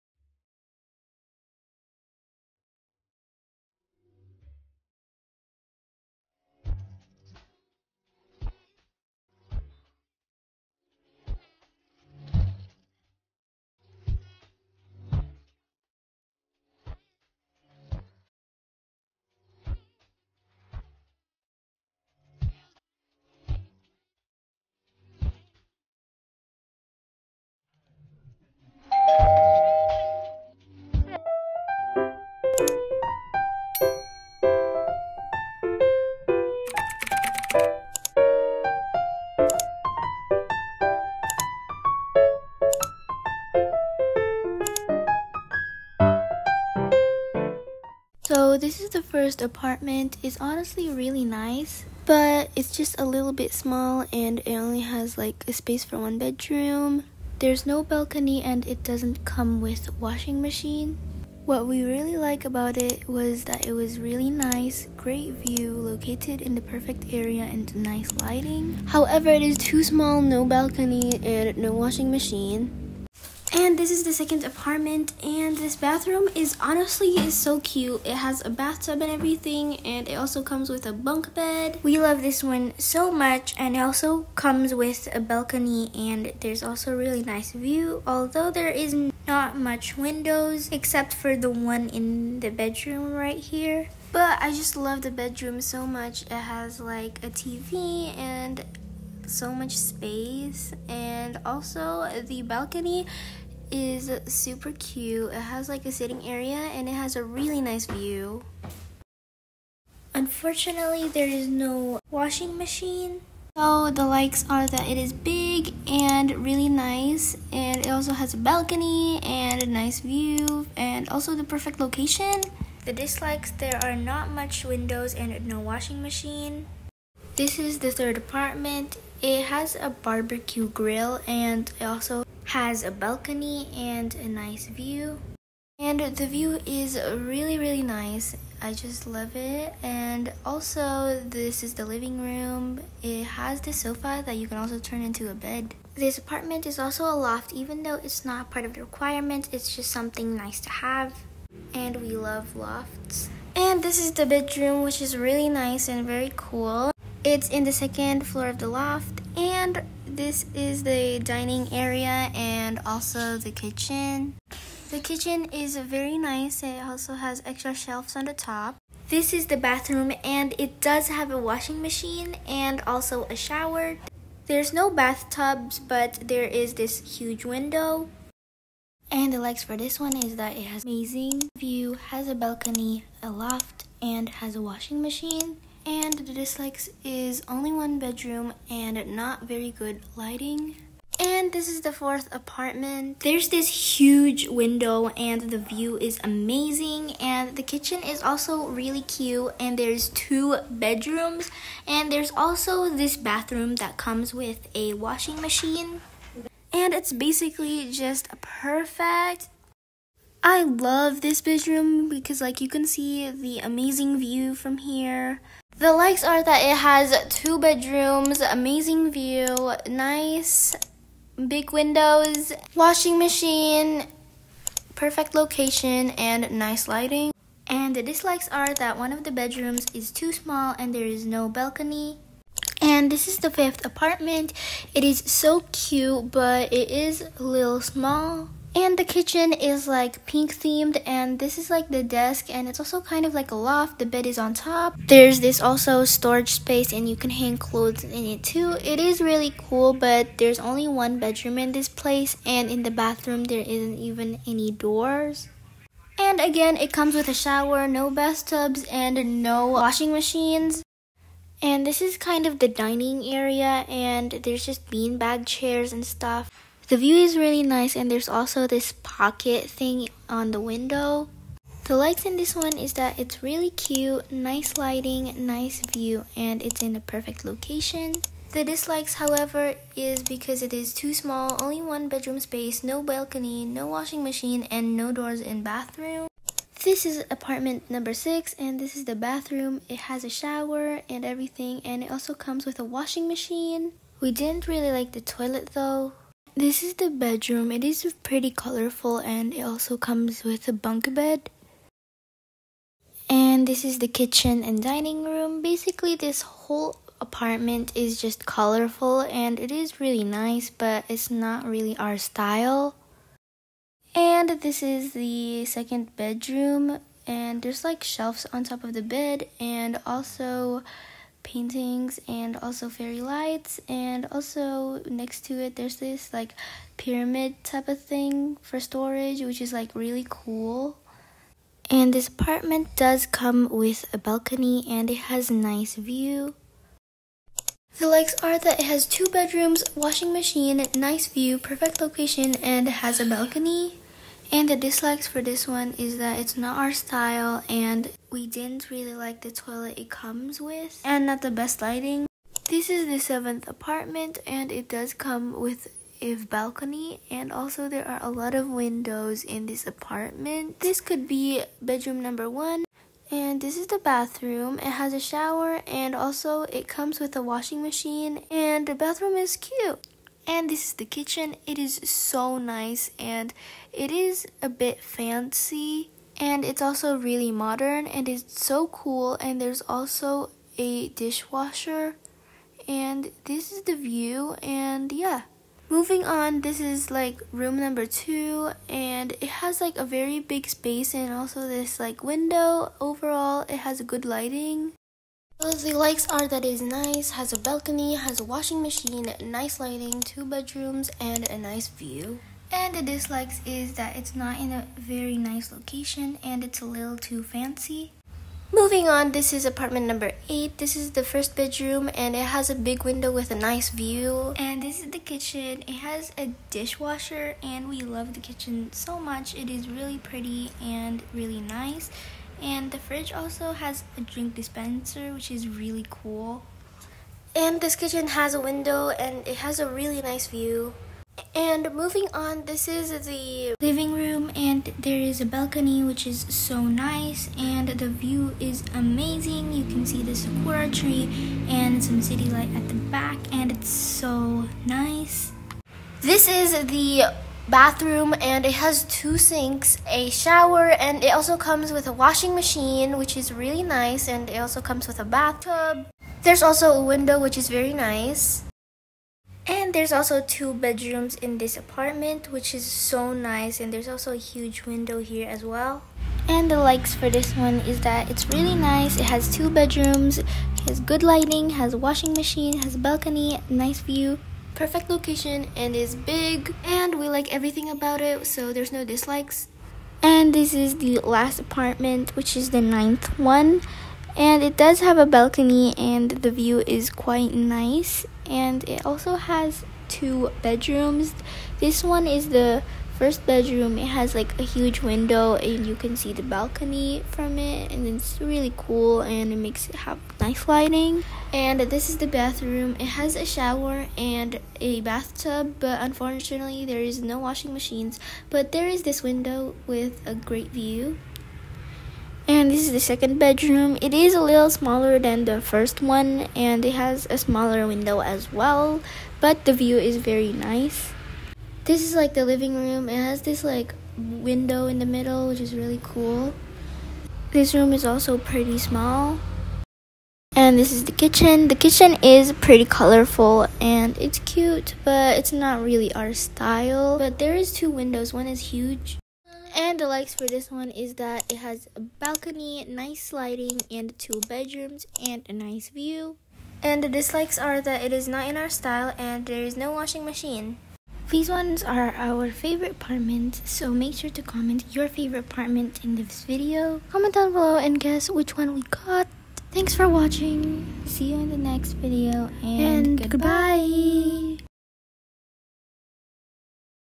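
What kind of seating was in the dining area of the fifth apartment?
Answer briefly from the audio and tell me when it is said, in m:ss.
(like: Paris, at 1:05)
Beanbag chairs, at 4:24.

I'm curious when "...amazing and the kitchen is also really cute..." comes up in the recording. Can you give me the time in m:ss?
3:16.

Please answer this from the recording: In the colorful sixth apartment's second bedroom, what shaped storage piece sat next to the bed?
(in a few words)
Pyramid.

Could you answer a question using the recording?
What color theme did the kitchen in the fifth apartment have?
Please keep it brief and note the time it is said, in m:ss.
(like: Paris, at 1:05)
Pink, at 4:00.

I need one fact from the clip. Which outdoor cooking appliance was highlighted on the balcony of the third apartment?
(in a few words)
Barbecue grill.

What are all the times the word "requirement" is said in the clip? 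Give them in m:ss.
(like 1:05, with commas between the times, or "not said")
2:28.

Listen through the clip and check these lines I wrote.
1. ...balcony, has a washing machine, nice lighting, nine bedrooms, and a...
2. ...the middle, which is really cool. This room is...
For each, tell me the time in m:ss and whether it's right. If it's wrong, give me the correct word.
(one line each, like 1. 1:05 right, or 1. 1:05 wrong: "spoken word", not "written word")
1. 6:37 wrong: "two", not "nine"
2. 8:44 right.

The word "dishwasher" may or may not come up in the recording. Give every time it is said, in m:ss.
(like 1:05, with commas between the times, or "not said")
6:21, 6:56.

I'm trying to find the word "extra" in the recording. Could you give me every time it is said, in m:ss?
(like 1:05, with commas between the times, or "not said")
2:47.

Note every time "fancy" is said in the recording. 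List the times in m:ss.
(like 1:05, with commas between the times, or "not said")
6:15, 6:47.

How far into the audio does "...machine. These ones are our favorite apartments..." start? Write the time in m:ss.
9:10.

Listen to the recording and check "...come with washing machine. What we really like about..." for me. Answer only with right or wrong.
right.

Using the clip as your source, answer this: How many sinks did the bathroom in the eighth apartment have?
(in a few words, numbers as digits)
2.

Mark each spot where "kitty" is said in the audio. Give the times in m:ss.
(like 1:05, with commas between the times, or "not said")
not said.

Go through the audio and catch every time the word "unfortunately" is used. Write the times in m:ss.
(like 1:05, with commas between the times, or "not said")
1:50, 8:26.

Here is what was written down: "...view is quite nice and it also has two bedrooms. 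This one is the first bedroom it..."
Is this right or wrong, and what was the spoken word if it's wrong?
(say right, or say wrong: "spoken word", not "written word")
right.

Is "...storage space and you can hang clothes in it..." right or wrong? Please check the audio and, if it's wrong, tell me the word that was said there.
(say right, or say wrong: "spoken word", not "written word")
right.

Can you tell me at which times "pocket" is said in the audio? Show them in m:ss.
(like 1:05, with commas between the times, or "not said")
4:29.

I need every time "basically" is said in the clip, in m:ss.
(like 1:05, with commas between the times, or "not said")
3:27, 5:05.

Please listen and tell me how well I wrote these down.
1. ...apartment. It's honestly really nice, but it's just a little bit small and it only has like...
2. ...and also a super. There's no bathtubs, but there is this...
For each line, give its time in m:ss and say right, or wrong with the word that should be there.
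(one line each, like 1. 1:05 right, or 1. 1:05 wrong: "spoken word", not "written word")
1. 0:49 right
2. 2:52 wrong: "shower", not "super".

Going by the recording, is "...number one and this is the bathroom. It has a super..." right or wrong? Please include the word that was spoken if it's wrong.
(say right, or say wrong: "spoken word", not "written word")
wrong: "shower", not "super".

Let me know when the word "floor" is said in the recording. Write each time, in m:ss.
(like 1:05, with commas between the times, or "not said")
2:38.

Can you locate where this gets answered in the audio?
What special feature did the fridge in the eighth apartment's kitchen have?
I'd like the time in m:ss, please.
7:04.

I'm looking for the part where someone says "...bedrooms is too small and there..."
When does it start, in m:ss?
3:49.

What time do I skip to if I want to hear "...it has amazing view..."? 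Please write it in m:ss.
3:00.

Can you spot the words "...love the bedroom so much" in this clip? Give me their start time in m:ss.
1:34.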